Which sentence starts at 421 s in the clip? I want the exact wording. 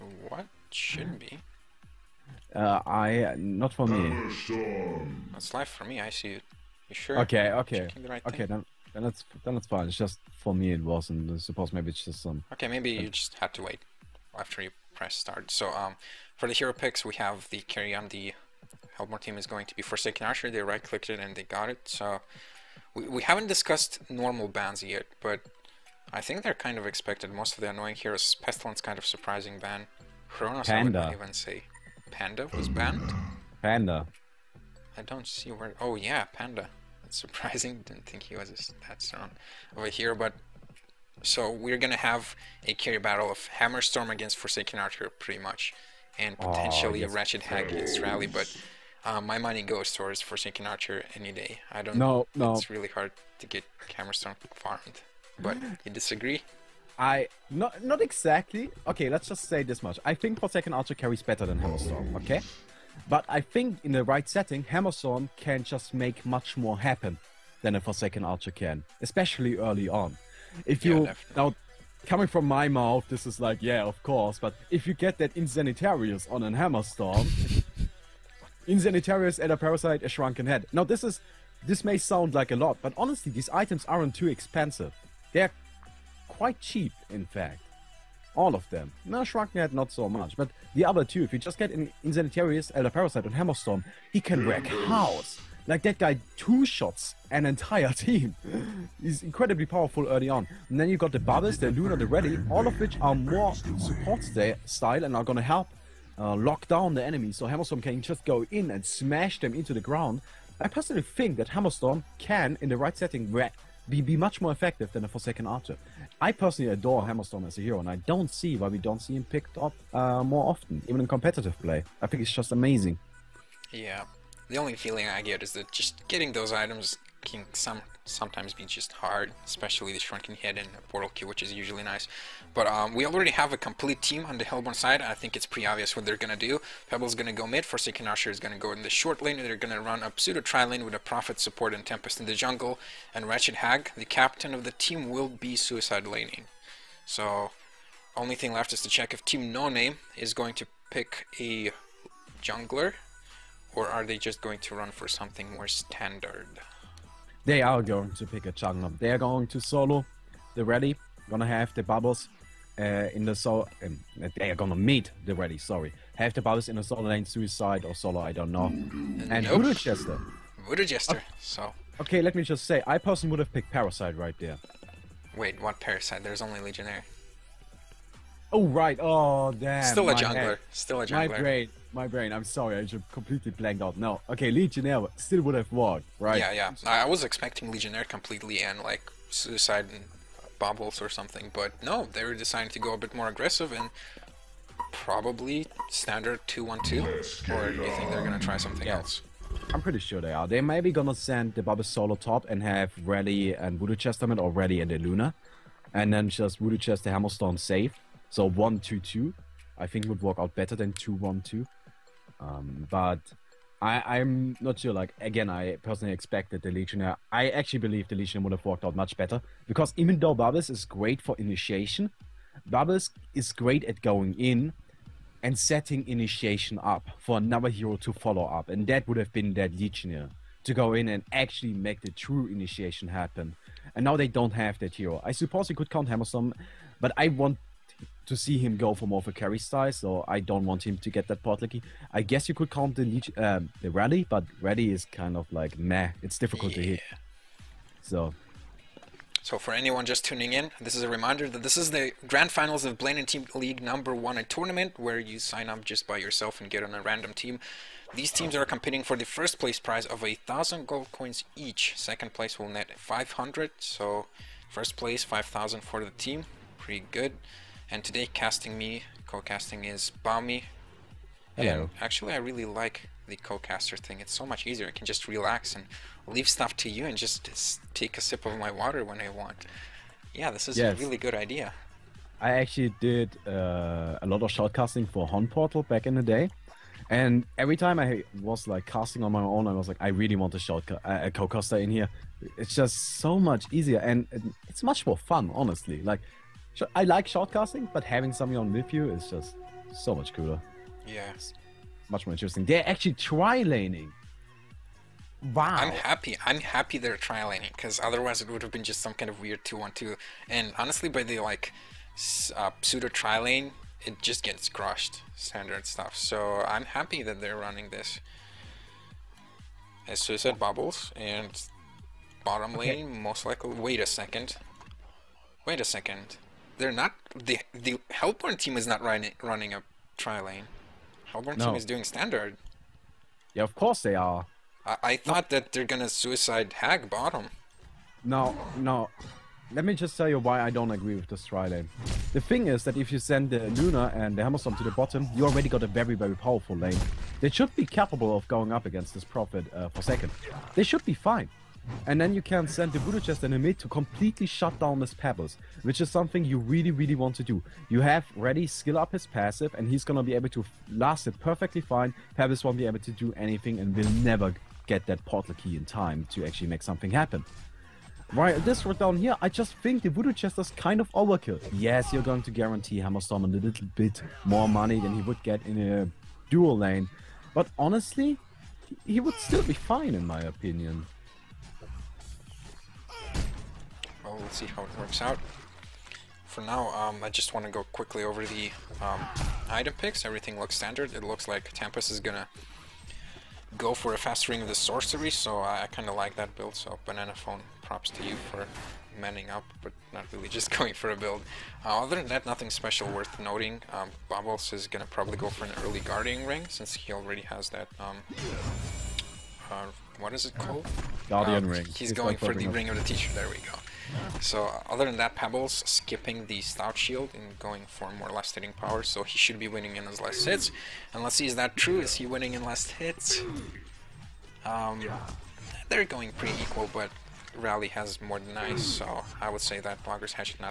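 And let's see, is that true?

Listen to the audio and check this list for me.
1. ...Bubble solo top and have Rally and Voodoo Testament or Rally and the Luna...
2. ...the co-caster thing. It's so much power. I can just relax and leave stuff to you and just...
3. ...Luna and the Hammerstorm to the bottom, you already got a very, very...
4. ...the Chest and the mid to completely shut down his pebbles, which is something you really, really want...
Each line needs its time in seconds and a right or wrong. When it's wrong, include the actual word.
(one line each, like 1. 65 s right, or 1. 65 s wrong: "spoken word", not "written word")
1. 201 s right
2. 273 s wrong: "easier", not "power"
3. 343 s right
4. 352 s right.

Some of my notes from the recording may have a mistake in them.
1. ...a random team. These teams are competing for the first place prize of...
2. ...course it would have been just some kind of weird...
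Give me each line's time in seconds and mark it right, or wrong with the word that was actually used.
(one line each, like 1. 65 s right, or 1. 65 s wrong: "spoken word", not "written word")
1. 256 s right
2. 307 s wrong: "otherwise", not "course".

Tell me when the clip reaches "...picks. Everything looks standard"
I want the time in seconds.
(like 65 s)
389 s.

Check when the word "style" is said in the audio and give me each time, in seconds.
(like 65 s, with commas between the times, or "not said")
104 s, 239 s.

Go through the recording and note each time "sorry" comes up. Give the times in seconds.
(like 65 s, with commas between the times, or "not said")
165 s, 182 s.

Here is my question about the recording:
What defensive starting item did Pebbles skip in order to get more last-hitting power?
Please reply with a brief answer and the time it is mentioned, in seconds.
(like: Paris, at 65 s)
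Stout Shield, at 416 s.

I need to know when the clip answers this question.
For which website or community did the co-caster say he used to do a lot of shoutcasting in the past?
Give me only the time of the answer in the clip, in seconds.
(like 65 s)
285 s.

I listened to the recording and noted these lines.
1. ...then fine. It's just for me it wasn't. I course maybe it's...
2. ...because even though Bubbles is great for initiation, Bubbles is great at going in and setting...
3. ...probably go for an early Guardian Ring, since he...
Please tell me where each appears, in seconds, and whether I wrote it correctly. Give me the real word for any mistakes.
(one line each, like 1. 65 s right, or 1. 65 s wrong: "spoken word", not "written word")
1. 9 s wrong: "suppose", not "course"
2. 219 s right
3. 405 s right.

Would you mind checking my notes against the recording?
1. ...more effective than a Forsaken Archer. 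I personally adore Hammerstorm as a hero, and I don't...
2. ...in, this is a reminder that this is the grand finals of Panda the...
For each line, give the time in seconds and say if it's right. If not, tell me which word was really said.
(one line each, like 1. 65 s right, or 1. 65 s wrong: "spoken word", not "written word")
1. 114 s right
2. 250 s wrong: "Blame", not "Panda".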